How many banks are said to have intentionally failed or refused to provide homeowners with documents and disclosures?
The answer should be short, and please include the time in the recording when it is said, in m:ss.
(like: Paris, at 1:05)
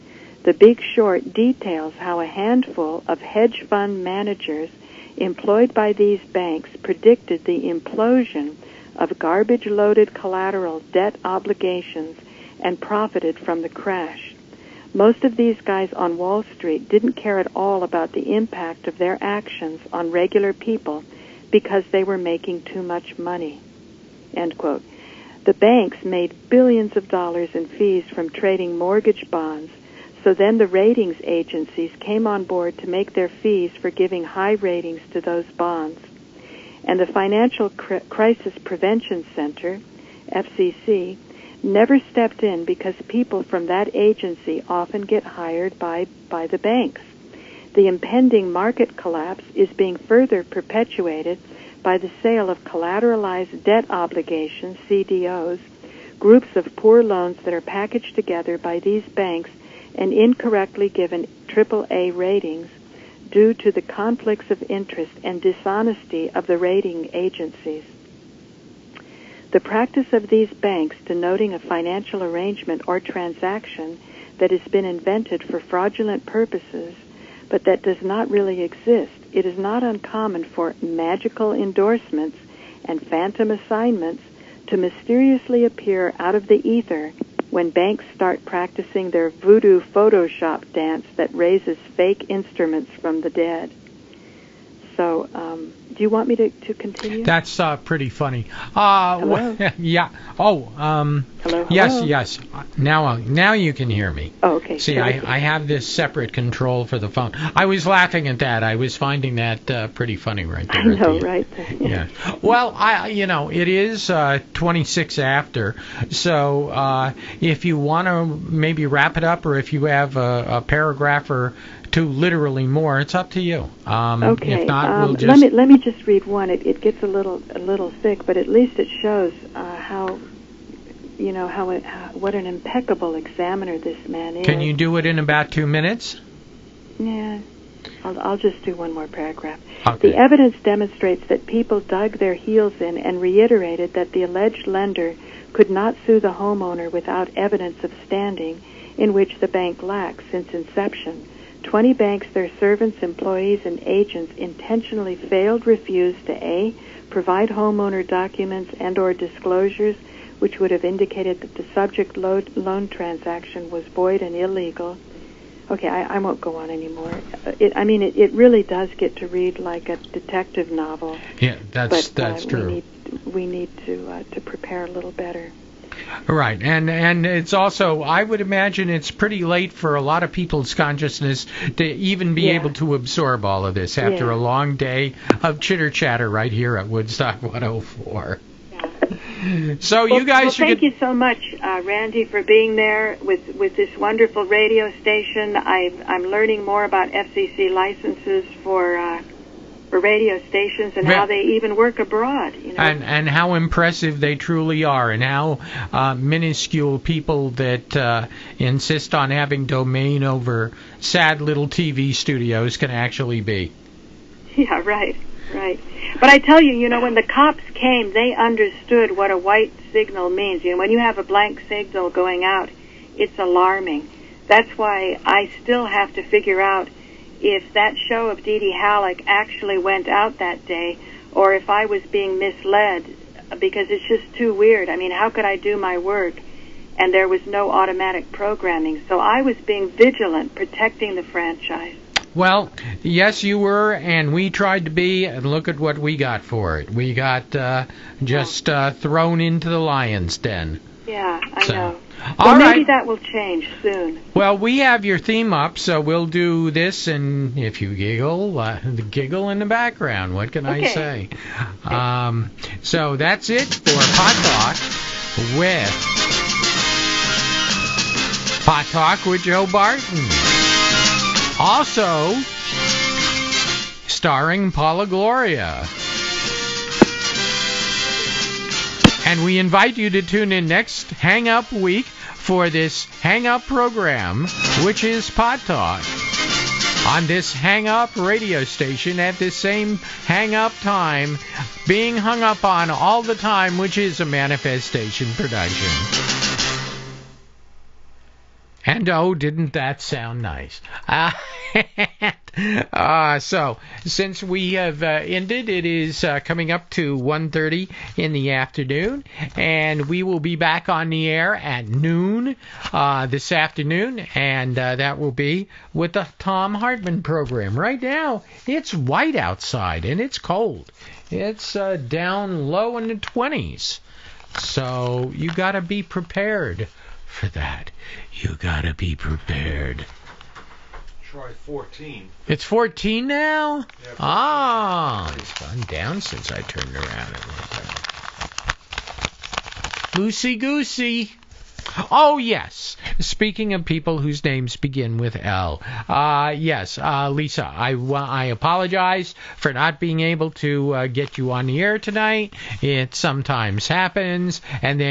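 20, at 2:31.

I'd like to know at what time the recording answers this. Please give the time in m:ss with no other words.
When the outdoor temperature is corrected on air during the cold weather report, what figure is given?
5:31.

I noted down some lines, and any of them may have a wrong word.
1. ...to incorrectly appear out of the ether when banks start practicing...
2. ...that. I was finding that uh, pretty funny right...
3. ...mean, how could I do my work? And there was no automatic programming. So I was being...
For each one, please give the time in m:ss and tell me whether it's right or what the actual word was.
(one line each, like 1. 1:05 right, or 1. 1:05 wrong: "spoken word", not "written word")
1. 1:24 wrong: "mysteriously", not "incorrectly"
2. 1:48 right
3. 3:54 right.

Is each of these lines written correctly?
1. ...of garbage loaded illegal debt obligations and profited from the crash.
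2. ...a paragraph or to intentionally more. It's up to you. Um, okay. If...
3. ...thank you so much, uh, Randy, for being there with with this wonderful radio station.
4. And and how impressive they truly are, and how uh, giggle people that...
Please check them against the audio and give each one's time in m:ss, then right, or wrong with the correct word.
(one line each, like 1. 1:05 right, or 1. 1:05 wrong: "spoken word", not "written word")
1. 0:08 wrong: "collateral", not "illegal"
2. 2:00 wrong: "literally", not "intentionally"
3. 3:10 right
4. 3:22 wrong: "minuscule", not "giggle".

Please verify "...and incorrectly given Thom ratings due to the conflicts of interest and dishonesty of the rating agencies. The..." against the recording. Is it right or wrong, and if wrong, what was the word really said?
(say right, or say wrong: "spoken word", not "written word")
wrong: "AAA", not "Thom".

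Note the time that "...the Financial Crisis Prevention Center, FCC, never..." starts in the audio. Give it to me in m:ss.
0:36.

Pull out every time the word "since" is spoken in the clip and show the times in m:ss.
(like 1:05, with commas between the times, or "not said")
2:30, 5:04, 5:36.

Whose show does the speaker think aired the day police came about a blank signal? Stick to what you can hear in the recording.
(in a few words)
Dee Dee Halleck.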